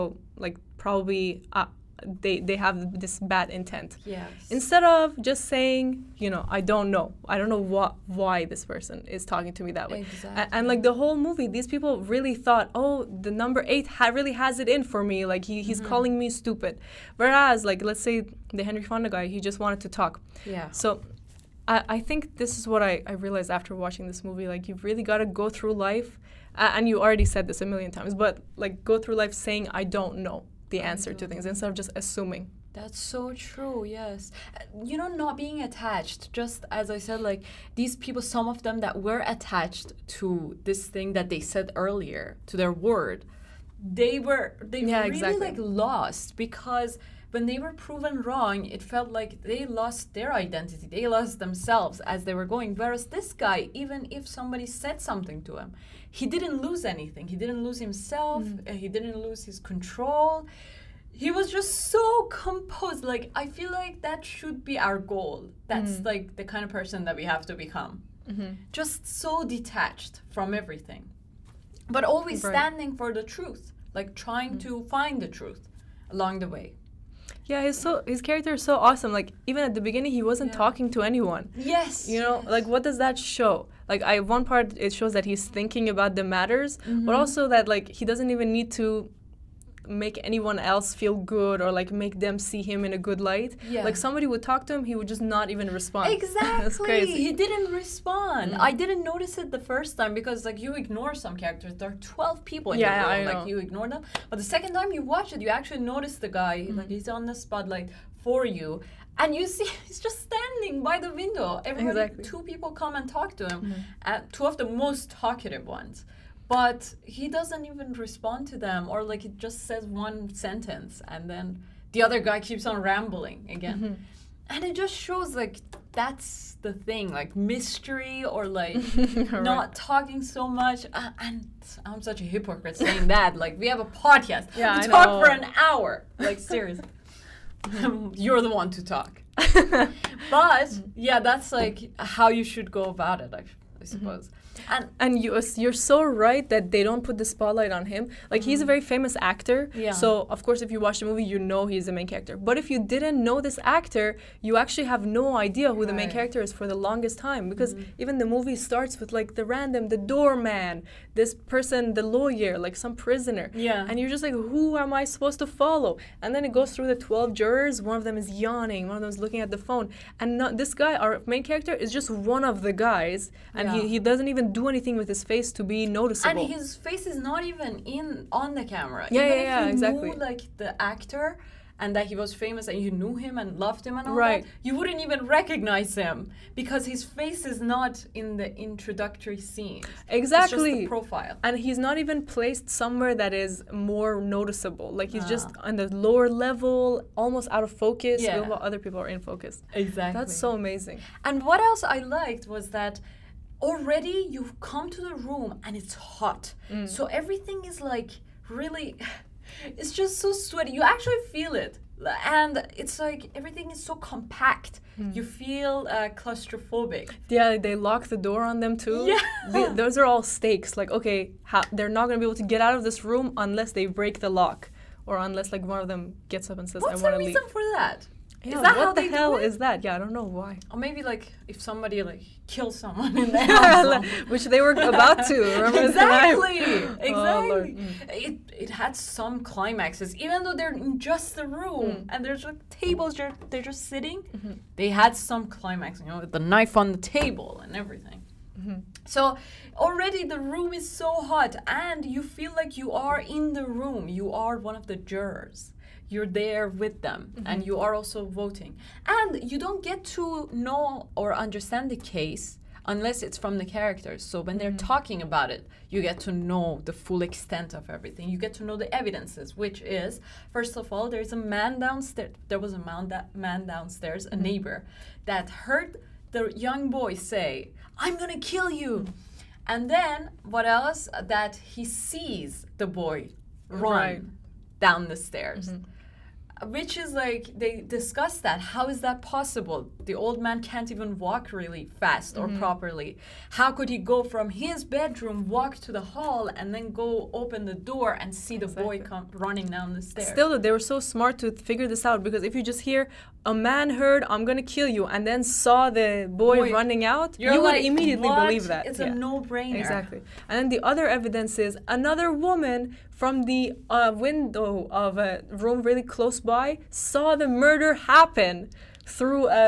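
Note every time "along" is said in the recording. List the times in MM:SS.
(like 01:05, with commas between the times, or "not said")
01:16.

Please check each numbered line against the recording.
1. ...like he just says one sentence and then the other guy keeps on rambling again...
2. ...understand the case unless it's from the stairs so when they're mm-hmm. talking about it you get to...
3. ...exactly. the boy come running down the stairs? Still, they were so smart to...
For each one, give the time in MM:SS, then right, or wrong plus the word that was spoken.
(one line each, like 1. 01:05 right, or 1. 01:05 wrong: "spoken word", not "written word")
1. 01:59 right
2. 04:21 wrong: "characters", not "stairs"
3. 04:58 right.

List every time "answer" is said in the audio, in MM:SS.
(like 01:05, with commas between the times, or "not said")
00:30.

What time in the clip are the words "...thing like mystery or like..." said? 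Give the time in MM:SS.
02:06.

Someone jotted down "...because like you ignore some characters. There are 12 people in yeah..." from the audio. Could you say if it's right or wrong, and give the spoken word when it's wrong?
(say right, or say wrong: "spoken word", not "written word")
right.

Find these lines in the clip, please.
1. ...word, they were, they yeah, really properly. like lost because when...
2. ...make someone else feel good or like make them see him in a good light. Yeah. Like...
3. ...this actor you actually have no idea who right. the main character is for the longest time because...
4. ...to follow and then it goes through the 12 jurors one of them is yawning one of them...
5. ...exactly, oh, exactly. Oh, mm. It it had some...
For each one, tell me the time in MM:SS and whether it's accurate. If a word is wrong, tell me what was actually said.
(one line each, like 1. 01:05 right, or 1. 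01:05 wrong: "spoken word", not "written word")
1. 00:42 wrong: "exactly", not "properly"
2. 01:29 wrong: "anyone", not "someone"
3. 02:33 right
4. 02:45 right
5. 03:55 right.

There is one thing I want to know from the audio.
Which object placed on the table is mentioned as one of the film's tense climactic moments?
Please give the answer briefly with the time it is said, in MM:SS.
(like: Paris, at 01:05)
The knife, at 04:06.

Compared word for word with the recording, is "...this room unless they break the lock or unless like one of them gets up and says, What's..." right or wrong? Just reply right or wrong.
right.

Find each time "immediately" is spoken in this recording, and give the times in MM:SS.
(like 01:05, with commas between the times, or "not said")
05:07.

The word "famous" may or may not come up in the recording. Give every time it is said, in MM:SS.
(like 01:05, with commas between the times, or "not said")
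02:28, 03:02.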